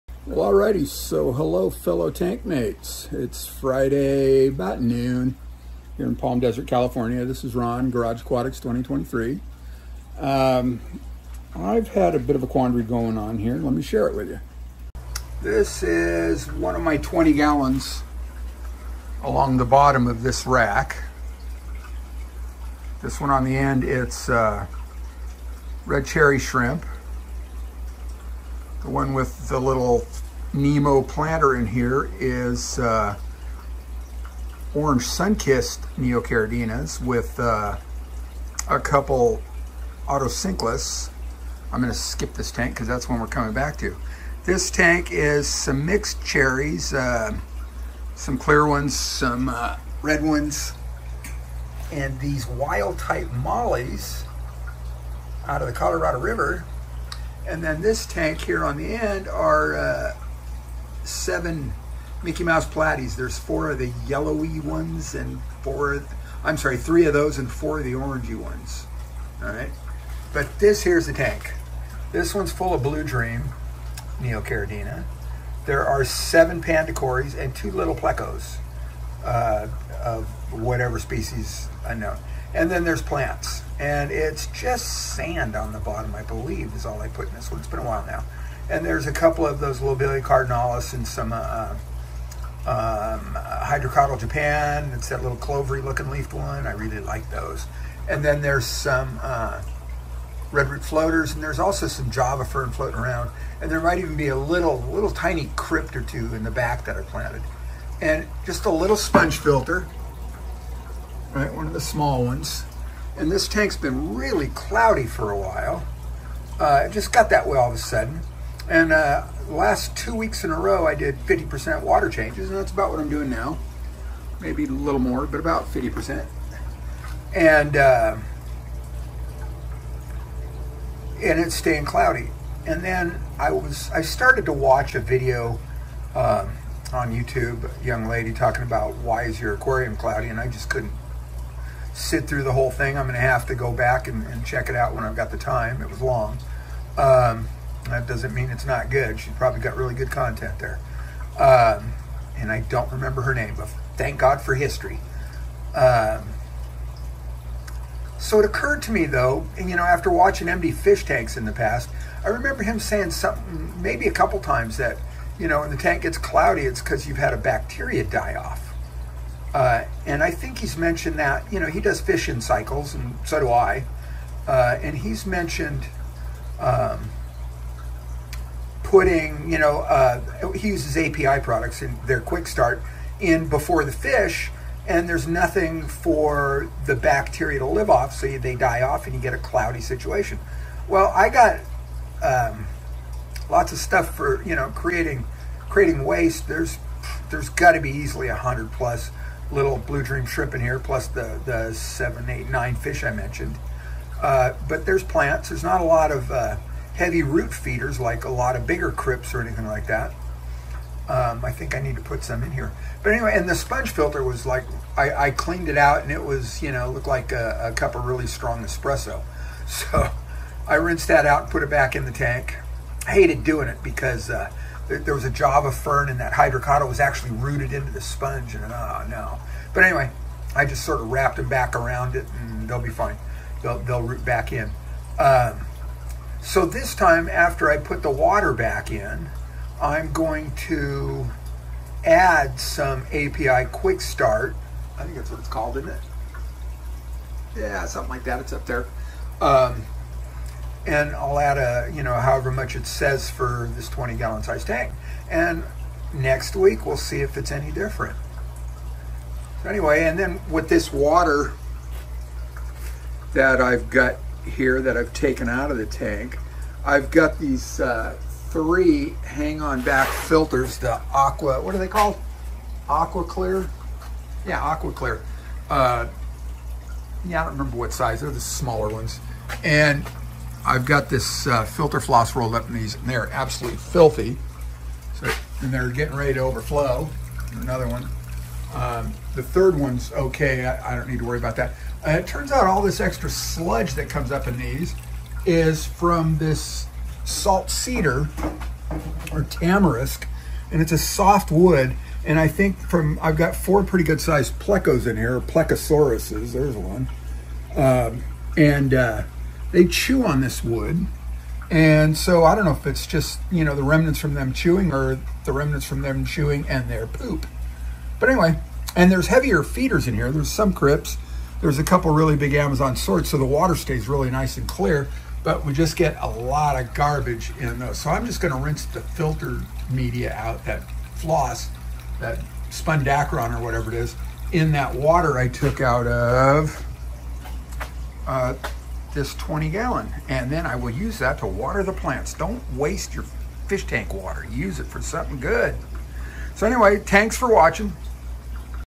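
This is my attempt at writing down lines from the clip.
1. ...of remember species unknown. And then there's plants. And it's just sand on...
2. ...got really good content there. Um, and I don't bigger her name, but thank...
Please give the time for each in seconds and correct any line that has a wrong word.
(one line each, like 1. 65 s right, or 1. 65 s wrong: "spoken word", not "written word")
1. 80 s wrong: "whatever", not "remember"
2. 149 s wrong: "remember", not "bigger".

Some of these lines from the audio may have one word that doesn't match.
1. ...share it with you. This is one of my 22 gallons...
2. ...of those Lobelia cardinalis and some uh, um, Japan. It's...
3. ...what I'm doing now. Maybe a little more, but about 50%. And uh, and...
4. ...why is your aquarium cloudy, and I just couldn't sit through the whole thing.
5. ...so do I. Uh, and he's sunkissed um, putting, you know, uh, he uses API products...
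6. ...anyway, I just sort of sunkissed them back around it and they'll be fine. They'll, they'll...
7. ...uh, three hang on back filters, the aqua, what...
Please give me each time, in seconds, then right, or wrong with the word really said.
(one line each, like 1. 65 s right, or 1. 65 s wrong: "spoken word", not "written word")
1. 13 s wrong: "20", not "22"
2. 89 s right
3. 122 s right
4. 138 s right
5. 173 s wrong: "mentioned", not "sunkissed"
6. 229 s wrong: "wrapped", not "sunkissed"
7. 267 s right.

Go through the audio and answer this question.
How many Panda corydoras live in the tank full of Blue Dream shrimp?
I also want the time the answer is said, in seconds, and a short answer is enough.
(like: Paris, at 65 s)
7, at 76 s.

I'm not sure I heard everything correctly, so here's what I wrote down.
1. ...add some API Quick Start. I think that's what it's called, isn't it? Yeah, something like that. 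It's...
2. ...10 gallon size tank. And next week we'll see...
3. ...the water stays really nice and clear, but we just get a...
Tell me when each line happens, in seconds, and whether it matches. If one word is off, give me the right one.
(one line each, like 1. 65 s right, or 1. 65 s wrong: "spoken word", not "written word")
1. 242 s right
2. 253 s wrong: "20", not "10"
3. 323 s right.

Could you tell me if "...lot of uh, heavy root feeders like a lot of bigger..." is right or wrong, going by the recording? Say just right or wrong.
right.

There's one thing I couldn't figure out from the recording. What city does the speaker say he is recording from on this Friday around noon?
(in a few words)
Palm Desert.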